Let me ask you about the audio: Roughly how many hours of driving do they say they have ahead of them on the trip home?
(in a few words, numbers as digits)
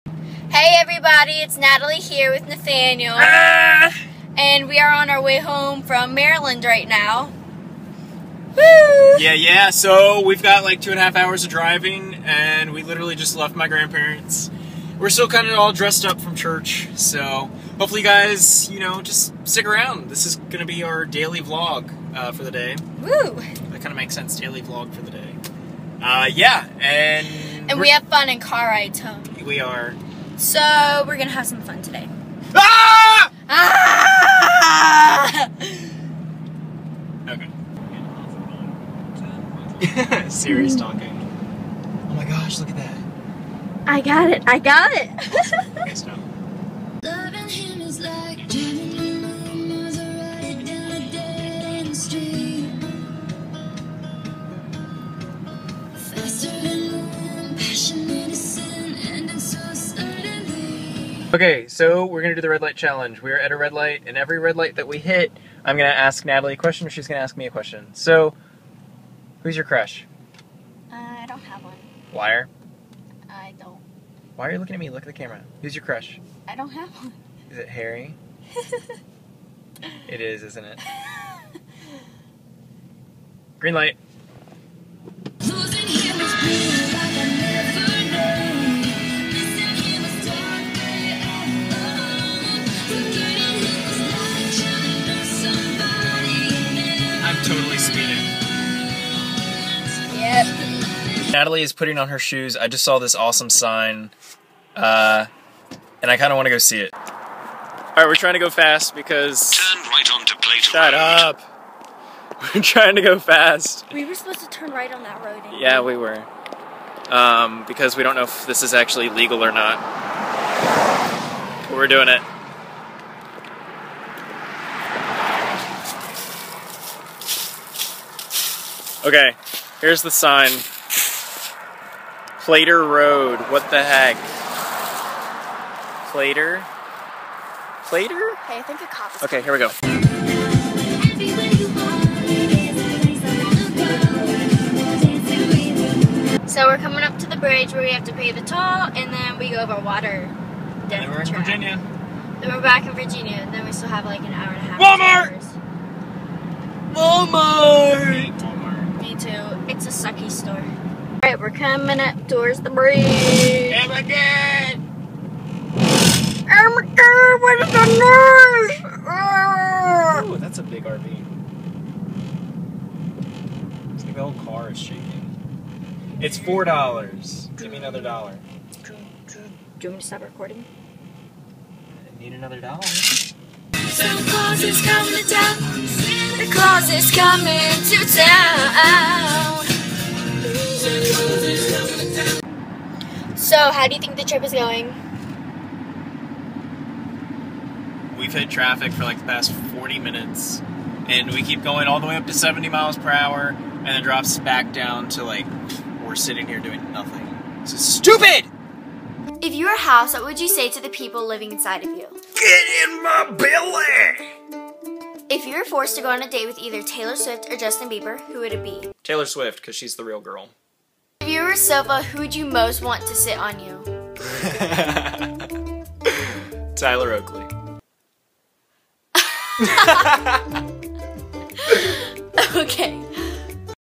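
2.5.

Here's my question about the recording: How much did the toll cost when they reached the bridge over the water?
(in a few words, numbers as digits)
$4.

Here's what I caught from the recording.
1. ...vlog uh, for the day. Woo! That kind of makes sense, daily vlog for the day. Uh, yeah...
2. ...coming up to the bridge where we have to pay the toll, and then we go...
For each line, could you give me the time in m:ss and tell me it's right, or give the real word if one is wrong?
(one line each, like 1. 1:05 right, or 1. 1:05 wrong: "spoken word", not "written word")
1. 0:21 right
2. 2:26 right.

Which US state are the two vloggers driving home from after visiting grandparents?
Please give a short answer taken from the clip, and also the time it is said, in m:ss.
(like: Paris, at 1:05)
Maryland, at 0:06.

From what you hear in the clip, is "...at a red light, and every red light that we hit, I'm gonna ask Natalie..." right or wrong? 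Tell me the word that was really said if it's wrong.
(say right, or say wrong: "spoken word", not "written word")
right.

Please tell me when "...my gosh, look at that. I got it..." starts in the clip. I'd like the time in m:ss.
0:42.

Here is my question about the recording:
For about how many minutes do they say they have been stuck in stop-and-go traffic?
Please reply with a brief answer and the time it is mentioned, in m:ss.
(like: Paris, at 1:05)
40, at 3:19.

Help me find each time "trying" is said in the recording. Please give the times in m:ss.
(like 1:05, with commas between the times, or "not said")
1:48, 1:52.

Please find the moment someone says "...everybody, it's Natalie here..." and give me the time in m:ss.
0:00.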